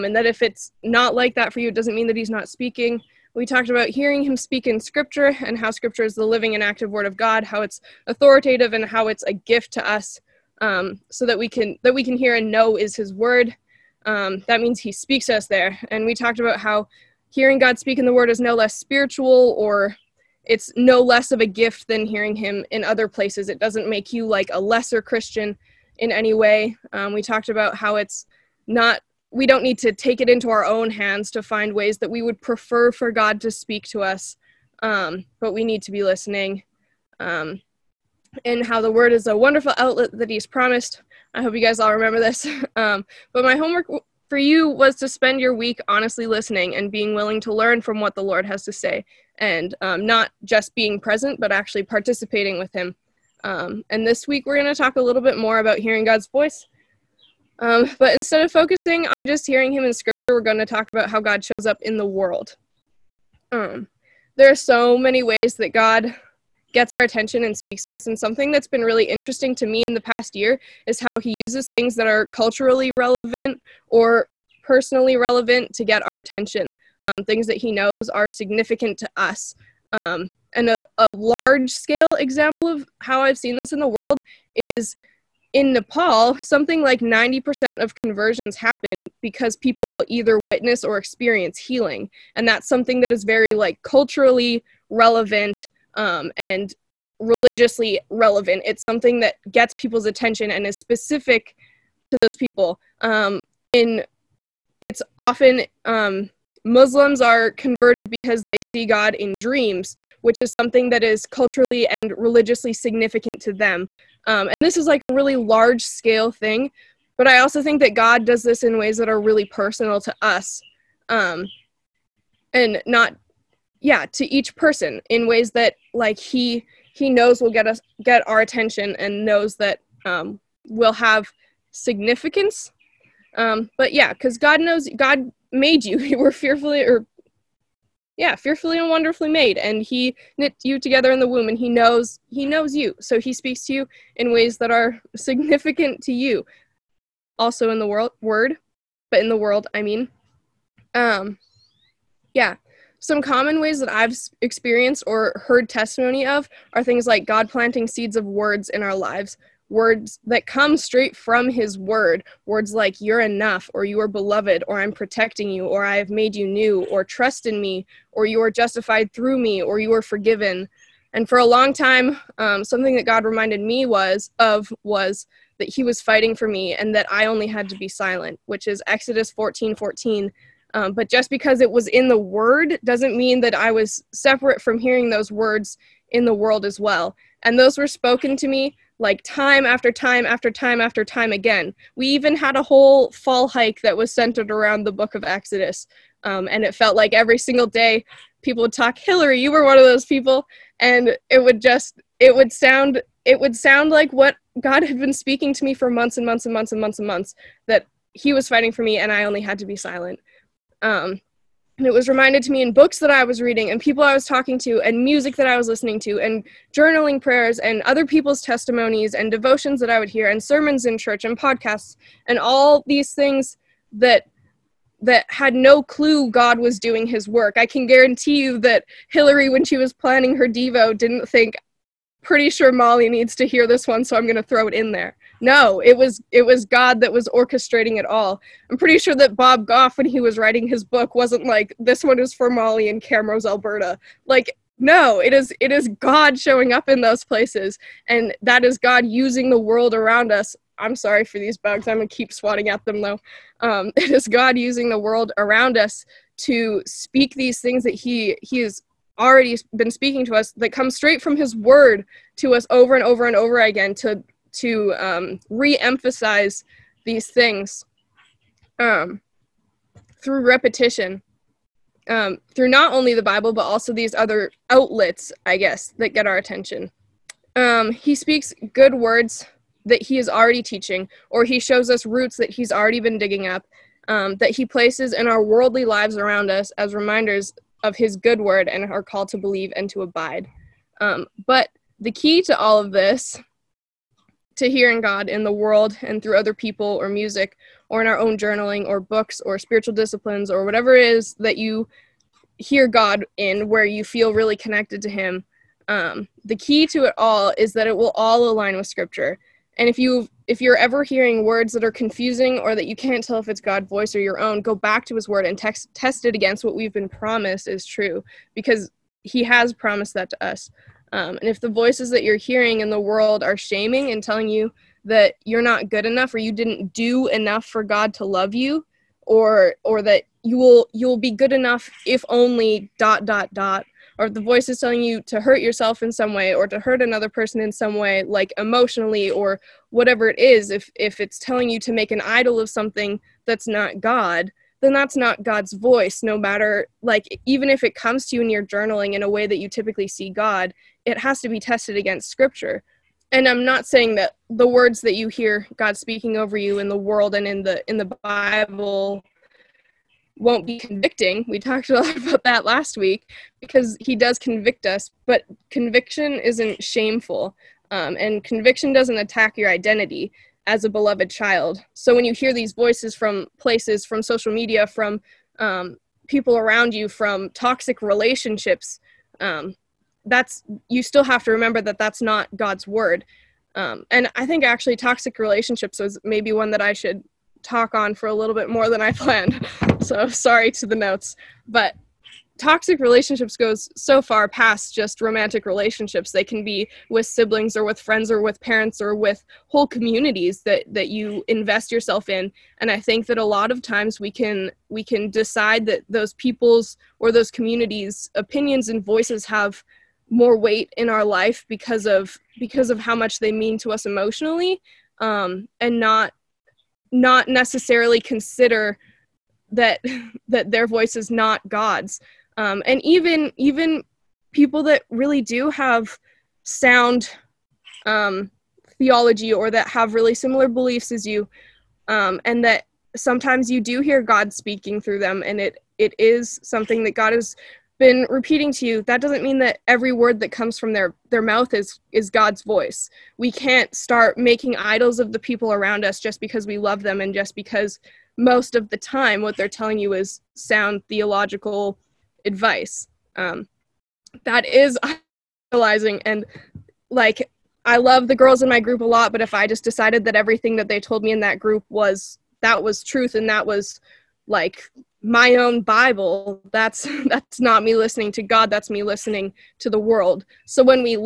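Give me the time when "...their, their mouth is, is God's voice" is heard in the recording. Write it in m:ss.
7:20.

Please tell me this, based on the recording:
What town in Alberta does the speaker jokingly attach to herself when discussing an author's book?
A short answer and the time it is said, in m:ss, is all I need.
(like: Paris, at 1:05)
Camrose, at 4:03.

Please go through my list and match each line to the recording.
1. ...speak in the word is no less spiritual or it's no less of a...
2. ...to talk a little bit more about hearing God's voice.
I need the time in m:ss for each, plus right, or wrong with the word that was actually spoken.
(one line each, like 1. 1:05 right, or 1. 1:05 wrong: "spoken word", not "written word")
1. 0:17 right
2. 0:54 right.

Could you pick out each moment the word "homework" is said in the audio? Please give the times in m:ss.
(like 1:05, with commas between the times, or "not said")
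0:43.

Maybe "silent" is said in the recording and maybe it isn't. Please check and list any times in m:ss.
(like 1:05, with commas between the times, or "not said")
2:57, 3:29.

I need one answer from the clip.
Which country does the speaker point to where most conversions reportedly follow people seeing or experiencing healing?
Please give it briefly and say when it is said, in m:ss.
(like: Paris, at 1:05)
Nepal, at 1:25.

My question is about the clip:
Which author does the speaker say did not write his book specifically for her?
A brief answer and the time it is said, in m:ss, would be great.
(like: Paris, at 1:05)
Bob Goff, at 3:59.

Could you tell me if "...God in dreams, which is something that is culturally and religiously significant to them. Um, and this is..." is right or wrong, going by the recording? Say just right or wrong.
right.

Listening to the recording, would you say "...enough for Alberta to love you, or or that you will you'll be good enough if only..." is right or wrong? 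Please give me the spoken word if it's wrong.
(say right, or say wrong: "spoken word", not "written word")
wrong: "God", not "Alberta".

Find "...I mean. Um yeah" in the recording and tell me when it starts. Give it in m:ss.
2:29.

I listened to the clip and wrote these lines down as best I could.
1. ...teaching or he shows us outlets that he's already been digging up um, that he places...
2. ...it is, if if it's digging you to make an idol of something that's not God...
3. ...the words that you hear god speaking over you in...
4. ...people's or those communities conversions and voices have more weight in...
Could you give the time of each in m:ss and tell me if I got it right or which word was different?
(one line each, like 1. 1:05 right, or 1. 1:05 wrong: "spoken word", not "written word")
1. 4:40 wrong: "roots", not "outlets"
2. 5:40 wrong: "telling", not "digging"
3. 5:54 right
4. 6:46 wrong: "opinions", not "conversions".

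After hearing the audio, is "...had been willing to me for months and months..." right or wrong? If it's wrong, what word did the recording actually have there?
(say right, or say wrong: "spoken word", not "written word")
wrong: "speaking", not "willing".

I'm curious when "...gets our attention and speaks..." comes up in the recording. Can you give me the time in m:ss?
1:06.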